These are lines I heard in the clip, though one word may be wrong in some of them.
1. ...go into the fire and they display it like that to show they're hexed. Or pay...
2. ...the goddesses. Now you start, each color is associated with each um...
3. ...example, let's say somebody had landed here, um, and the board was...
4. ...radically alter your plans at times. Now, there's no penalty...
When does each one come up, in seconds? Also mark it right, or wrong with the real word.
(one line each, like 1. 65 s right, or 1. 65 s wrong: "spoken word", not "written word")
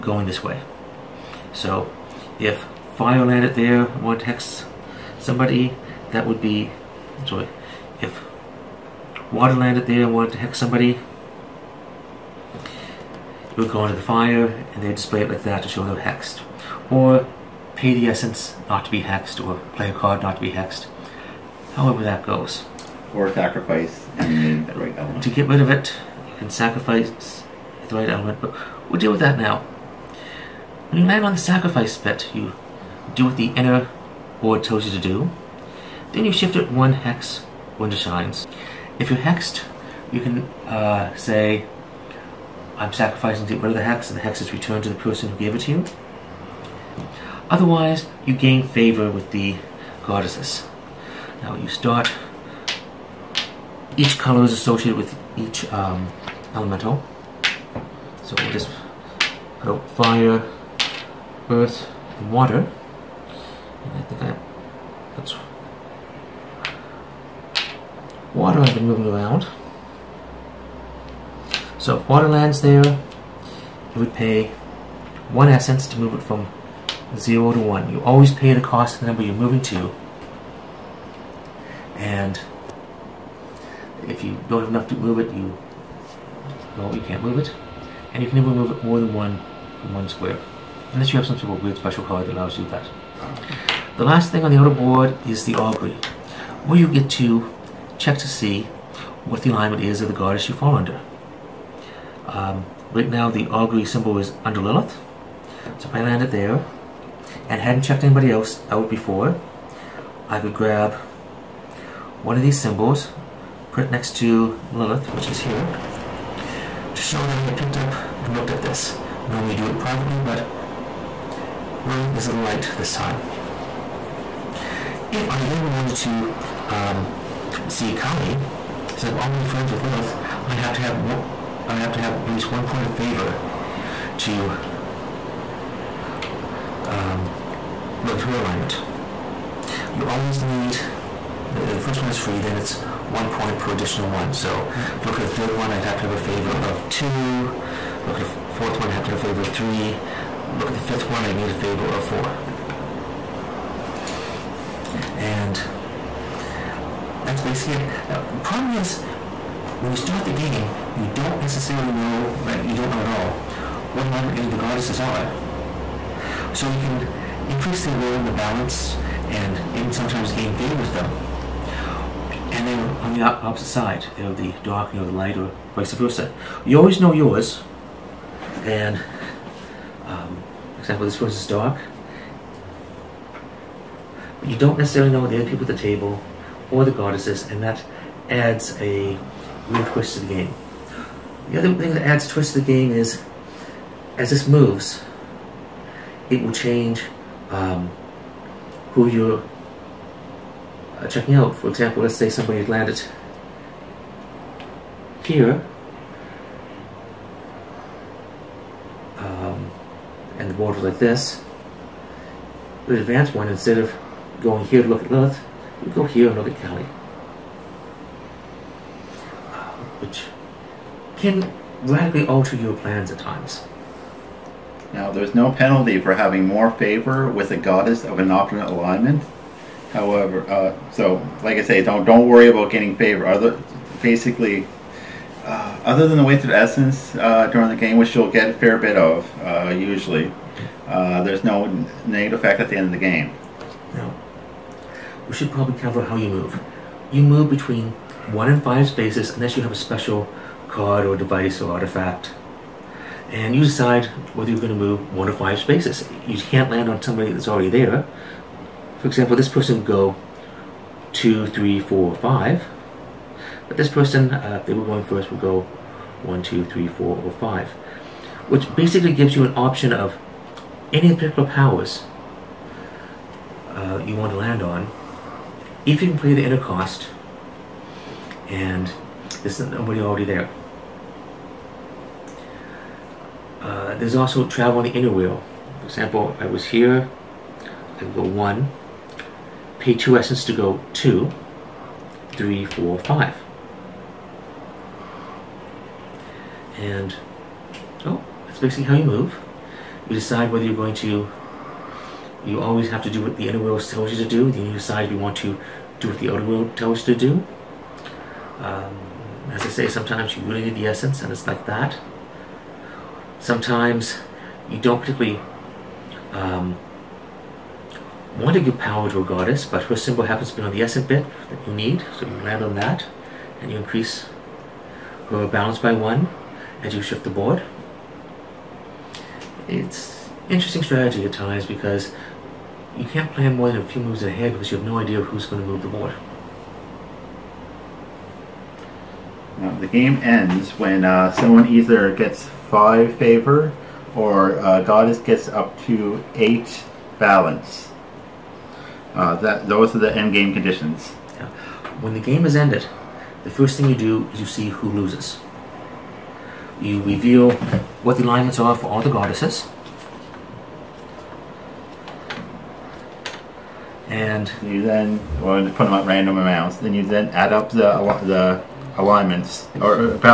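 1. 13 s right
2. 49 s right
3. 201 s right
4. 221 s right.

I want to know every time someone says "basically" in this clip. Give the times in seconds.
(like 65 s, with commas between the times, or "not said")
157 s, 234 s, 268 s, 298 s.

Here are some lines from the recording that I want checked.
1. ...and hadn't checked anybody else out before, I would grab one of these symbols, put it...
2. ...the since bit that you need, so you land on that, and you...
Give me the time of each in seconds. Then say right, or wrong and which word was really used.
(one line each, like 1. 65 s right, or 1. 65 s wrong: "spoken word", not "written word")
1. 107 s right
2. 320 s wrong: "essence", not "since".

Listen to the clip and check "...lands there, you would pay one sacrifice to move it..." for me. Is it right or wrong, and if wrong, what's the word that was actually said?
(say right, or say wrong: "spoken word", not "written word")
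wrong: "essence", not "sacrifice".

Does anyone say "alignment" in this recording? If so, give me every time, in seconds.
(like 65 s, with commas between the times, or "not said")
99 s, 138 s, 164 s, 228 s, 358 s, 368 s.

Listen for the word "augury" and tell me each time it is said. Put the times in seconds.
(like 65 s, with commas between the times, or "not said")
95 s, 103 s.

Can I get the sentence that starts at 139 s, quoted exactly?
You always need uh, the first one is free, then it's one point per additional one.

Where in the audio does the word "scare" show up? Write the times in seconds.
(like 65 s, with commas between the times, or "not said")
not said.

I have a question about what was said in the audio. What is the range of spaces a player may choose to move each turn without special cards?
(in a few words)
1 to 5.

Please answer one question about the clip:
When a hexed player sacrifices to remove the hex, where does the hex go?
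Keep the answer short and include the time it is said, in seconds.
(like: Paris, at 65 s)
To the person who gave it, at 44 s.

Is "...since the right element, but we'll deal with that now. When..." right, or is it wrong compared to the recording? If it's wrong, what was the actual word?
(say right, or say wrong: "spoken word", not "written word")
wrong: "sacrifice", not "since".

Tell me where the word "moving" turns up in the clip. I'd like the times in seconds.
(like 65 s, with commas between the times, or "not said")
68 s, 79 s.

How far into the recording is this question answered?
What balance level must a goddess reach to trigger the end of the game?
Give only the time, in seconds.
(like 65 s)
346 s.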